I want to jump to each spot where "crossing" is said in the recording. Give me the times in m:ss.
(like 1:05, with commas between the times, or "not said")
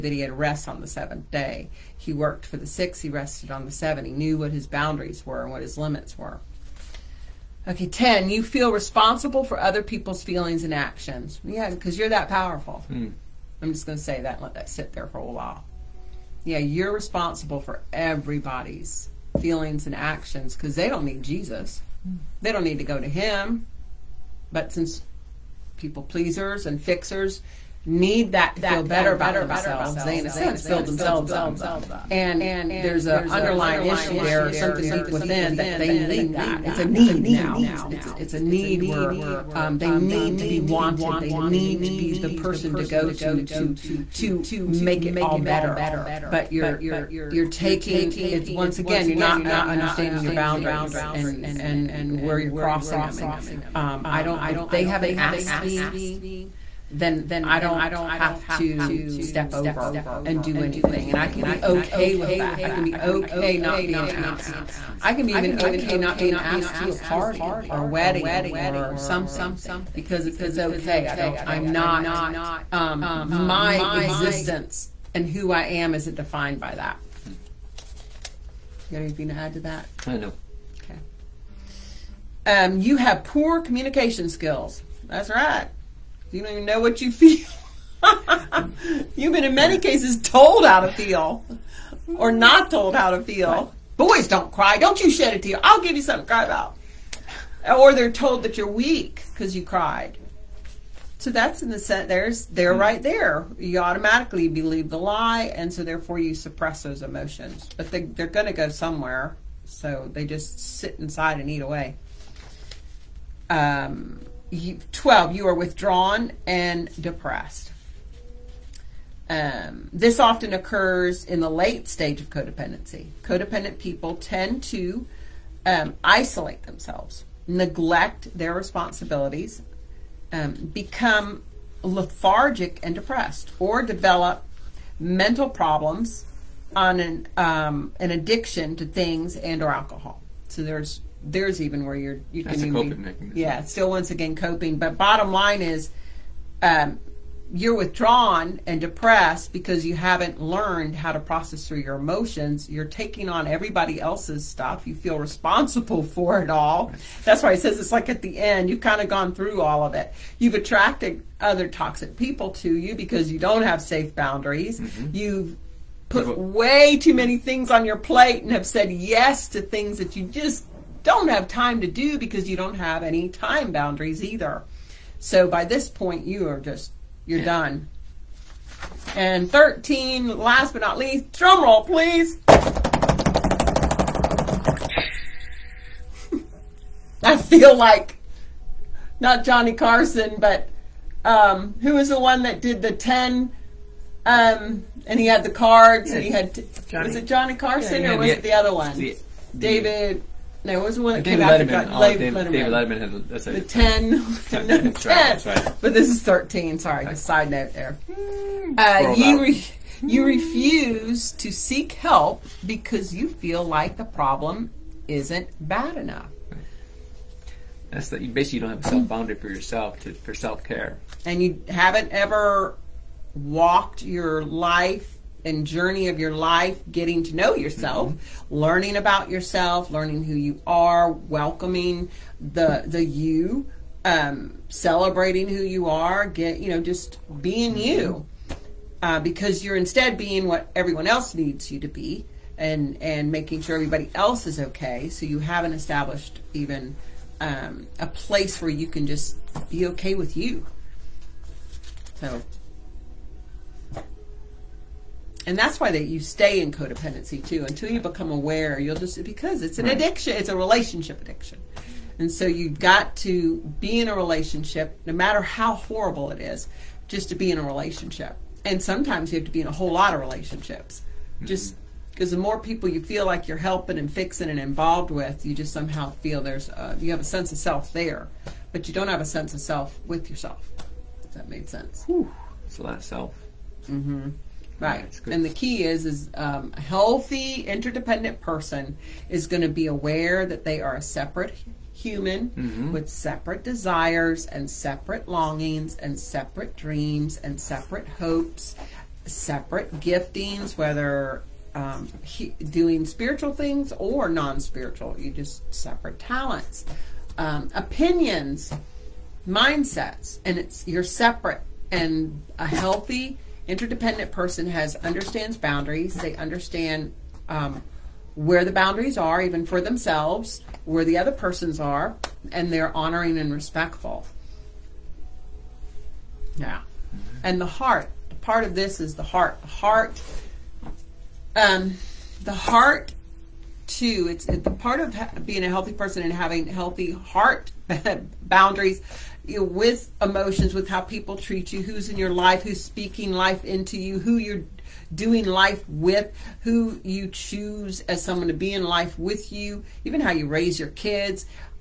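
0:52.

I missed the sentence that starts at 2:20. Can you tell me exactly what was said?
So there's there's even where you're you That's can a coping mechanism.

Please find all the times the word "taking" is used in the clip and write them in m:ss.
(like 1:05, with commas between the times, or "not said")
0:47, 2:32.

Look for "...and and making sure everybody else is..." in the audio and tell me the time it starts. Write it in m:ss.
4:02.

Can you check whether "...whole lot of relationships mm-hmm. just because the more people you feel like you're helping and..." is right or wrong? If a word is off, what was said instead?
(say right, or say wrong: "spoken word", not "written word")
right.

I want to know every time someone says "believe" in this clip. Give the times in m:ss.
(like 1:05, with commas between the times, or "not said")
1:44.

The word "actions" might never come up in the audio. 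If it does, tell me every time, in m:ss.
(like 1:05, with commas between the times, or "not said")
0:10, 0:19.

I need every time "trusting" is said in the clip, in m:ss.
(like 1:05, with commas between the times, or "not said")
not said.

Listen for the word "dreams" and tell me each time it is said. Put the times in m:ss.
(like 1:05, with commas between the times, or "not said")
4:56.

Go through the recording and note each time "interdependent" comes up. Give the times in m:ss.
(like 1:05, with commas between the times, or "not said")
4:47, 5:13.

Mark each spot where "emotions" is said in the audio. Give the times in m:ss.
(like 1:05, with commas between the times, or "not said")
1:47, 2:31, 5:40.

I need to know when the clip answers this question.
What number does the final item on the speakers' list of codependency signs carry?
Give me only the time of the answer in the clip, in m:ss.
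2:59.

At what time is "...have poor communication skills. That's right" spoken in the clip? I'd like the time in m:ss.
1:22.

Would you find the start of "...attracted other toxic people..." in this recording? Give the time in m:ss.
2:40.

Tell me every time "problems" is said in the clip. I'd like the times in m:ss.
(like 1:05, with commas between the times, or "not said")
2:15, 3:34.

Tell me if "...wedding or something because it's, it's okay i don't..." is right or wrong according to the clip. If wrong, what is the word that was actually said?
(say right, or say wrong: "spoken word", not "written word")
right.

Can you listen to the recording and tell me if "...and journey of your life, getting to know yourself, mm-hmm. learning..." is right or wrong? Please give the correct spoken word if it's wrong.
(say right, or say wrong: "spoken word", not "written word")
right.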